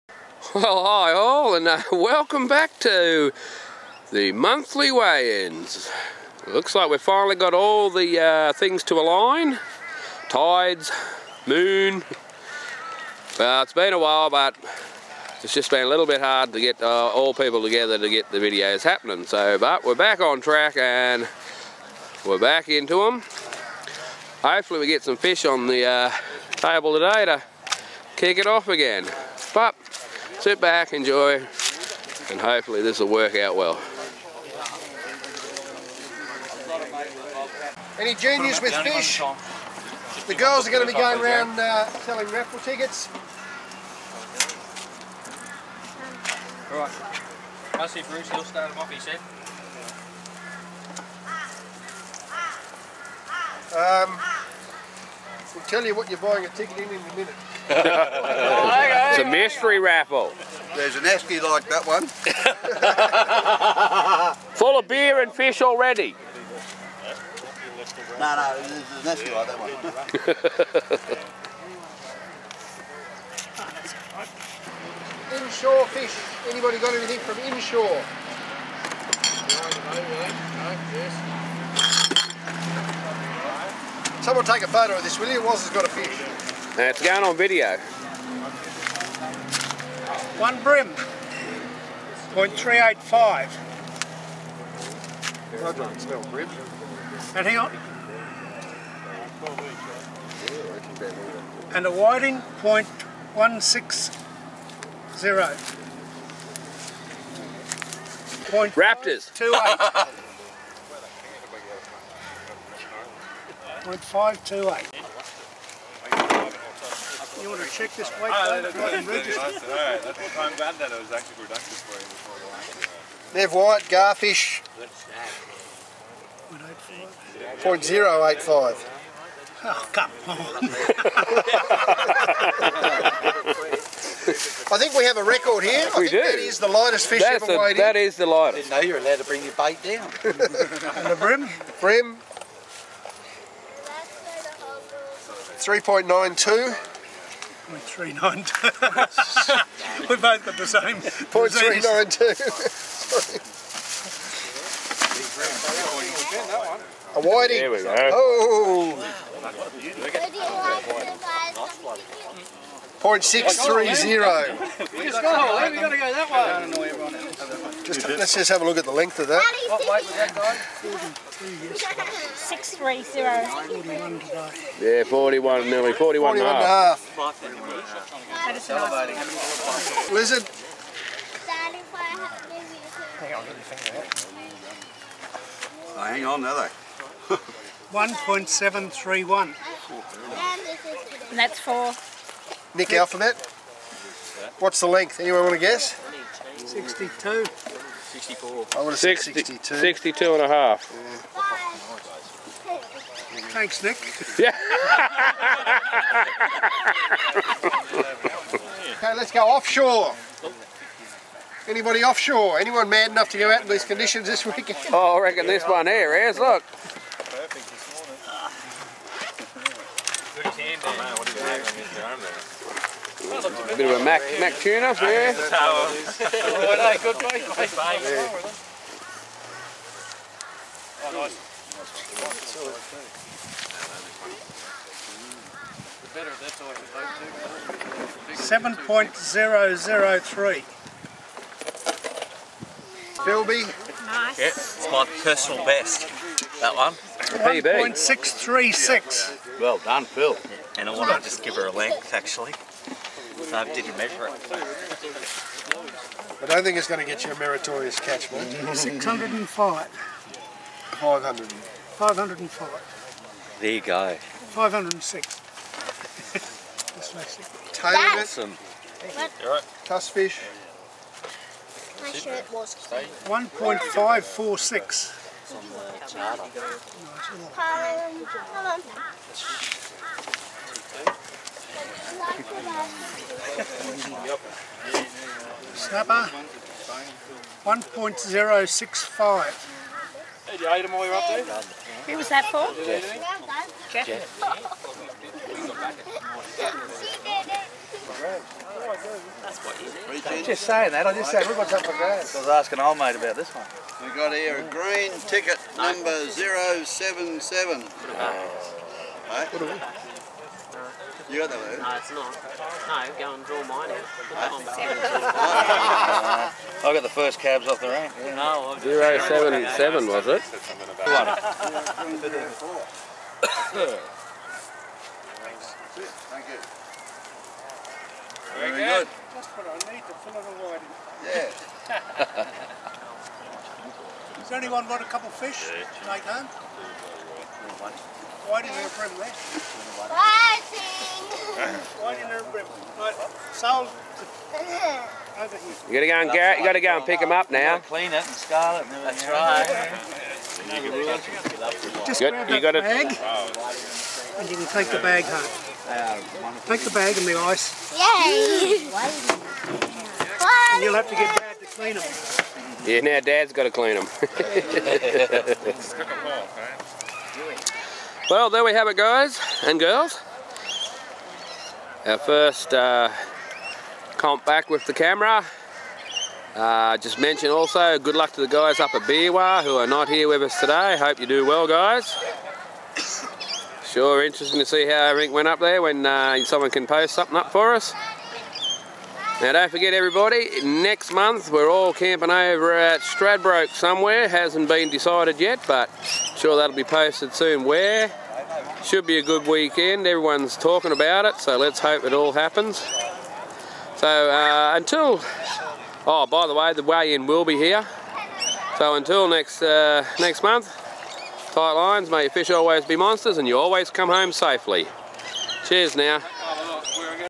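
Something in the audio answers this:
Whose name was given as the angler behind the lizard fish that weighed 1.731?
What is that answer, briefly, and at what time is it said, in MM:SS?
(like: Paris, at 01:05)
Nick Alphabet, at 03:12.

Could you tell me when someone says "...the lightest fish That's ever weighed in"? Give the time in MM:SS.
02:16.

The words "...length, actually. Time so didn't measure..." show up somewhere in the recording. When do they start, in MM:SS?
04:11.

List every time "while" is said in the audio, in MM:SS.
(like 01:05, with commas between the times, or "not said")
00:13, 04:50.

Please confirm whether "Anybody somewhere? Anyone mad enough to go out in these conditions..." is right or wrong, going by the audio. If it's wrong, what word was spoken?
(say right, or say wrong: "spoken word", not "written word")
wrong: "offshore", not "somewhere".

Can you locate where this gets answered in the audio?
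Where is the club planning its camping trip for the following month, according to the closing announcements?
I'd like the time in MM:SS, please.
06:33.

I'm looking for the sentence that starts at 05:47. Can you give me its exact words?
Clean it and scarlet and That's right.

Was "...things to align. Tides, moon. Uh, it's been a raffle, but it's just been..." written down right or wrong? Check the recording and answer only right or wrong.
wrong.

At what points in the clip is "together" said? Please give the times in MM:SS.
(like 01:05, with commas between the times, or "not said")
00:17.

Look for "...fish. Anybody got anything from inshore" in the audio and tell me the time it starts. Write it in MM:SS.
01:15.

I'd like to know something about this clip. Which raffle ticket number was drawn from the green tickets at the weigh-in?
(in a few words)
077.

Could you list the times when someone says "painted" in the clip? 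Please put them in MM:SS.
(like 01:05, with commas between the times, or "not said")
not said.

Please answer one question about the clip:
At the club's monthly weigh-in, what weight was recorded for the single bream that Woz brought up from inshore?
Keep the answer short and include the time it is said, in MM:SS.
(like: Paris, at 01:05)
0.385, at 01:32.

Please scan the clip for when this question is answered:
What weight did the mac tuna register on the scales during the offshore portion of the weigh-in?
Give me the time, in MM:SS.
03:58.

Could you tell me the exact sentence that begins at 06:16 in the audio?
Uh, just mention also, good luck to the guys up at Biwa who are not here with us today.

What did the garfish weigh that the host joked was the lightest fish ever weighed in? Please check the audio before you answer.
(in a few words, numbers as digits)
0.085.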